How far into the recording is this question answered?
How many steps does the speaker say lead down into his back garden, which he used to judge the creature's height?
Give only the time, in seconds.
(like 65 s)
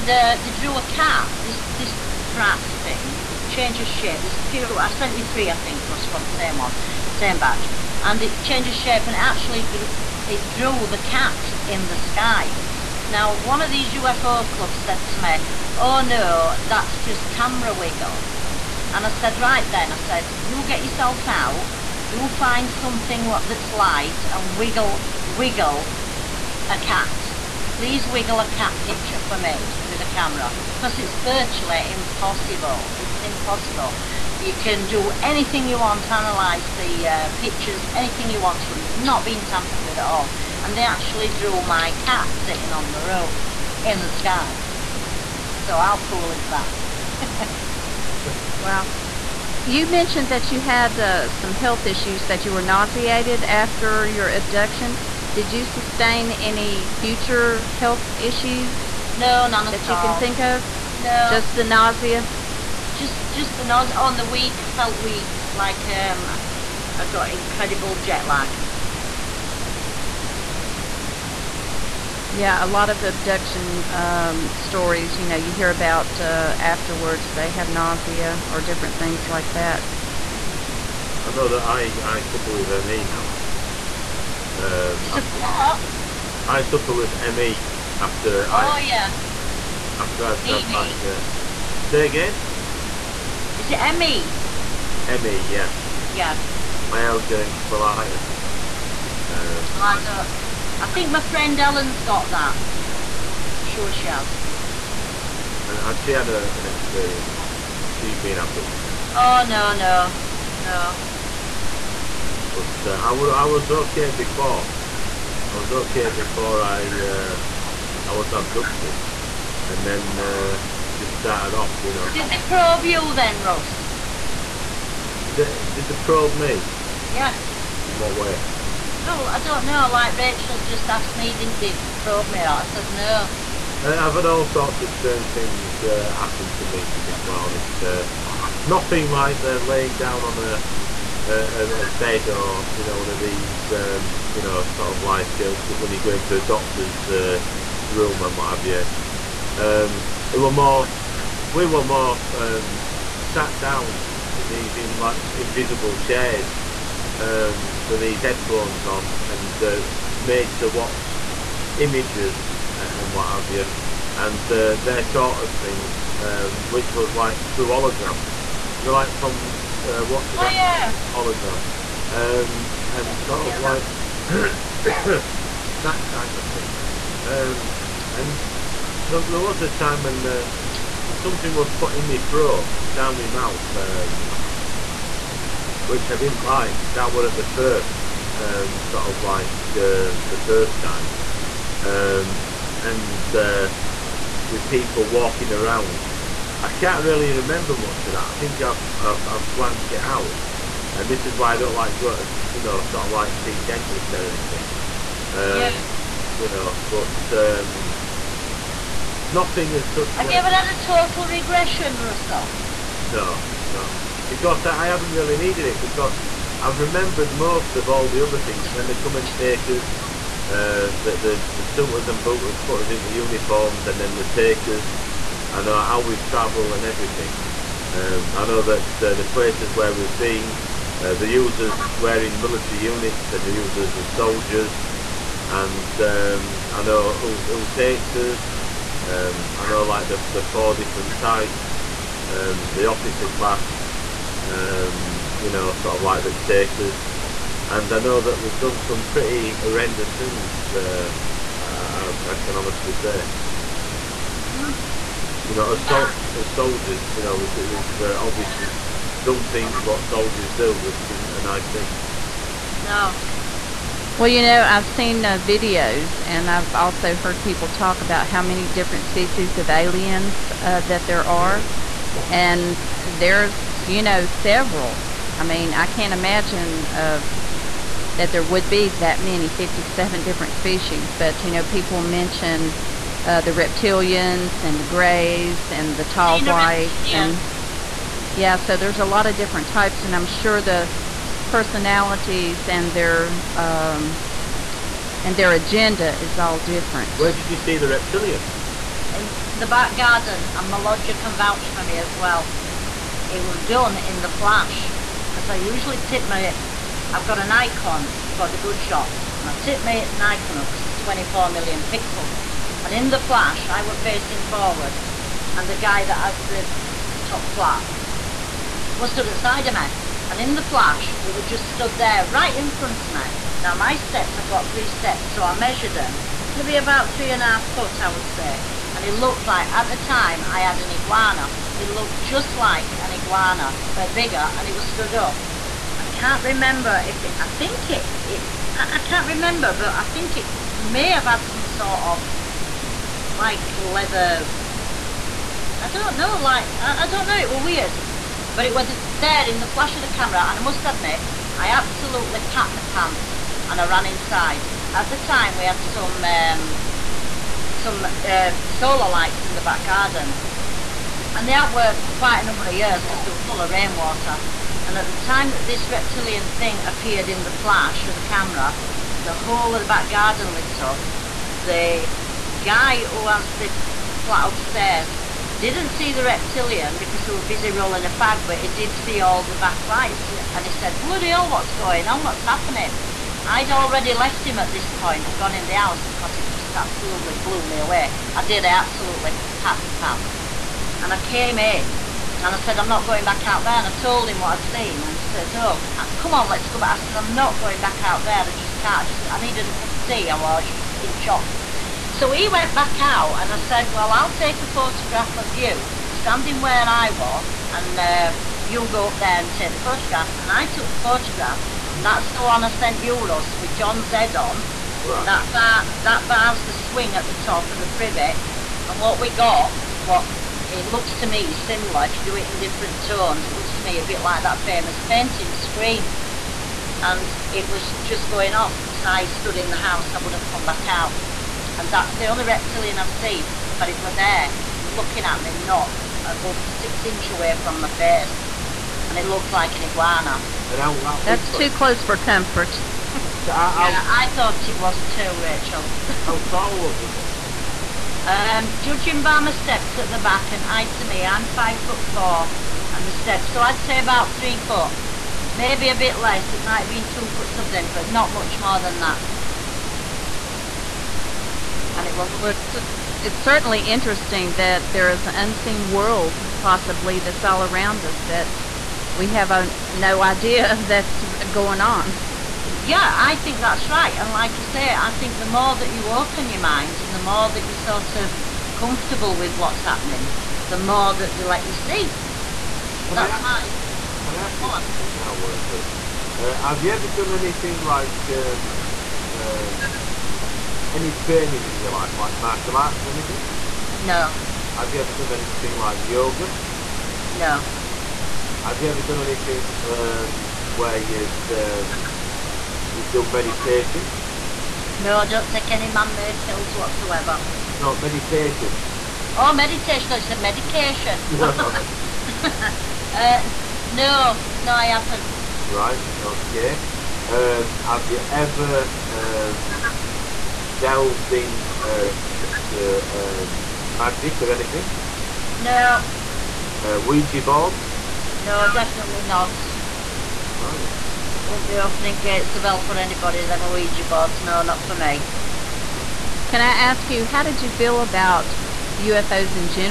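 324 s.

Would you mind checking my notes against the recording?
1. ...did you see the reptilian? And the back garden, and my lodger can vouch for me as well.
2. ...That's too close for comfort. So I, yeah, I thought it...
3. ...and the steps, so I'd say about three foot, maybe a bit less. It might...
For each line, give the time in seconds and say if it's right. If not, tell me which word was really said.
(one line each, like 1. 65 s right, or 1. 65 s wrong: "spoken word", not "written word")
1. 297 s right
2. 441 s right
3. 452 s right.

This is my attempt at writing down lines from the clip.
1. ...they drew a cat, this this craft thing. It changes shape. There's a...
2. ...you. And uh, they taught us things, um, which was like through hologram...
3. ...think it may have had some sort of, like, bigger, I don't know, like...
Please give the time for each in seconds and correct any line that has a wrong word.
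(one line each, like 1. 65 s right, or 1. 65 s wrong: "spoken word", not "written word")
1. 0 s right
2. 163 s right
3. 340 s wrong: "leather", not "bigger".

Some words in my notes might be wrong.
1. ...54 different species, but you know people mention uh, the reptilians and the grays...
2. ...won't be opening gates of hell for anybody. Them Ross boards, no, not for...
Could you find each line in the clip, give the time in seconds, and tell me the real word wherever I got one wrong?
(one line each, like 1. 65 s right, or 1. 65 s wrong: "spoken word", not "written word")
1. 279 s wrong: "57", not "54"
2. 531 s wrong: "Ouija", not "Ross".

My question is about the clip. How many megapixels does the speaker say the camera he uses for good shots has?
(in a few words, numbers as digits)
24.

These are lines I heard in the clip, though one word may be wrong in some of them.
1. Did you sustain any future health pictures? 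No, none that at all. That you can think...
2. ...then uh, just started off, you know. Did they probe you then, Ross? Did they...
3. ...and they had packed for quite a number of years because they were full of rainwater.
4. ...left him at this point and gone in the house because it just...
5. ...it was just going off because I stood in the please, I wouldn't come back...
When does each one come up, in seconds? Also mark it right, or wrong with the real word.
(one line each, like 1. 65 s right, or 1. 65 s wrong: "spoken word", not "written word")
1. 55 s wrong: "issues", not "pictures"
2. 119 s right
3. 361 s wrong: "worked", not "packed"
4. 384 s right
5. 427 s wrong: "house", not "please".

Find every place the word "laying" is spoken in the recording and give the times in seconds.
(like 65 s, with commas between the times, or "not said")
139 s.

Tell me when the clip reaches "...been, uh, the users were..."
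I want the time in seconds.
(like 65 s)
230 s.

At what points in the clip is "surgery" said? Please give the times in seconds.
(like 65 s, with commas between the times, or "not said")
not said.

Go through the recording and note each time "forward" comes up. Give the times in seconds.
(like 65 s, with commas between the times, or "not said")
314 s.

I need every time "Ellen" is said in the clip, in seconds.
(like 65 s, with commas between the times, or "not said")
101 s.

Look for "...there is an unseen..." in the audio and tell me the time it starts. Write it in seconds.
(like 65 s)
464 s.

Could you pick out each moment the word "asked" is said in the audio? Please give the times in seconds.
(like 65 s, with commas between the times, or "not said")
130 s.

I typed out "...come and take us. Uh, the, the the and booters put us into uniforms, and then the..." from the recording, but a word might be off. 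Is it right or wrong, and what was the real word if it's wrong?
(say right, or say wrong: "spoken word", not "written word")
right.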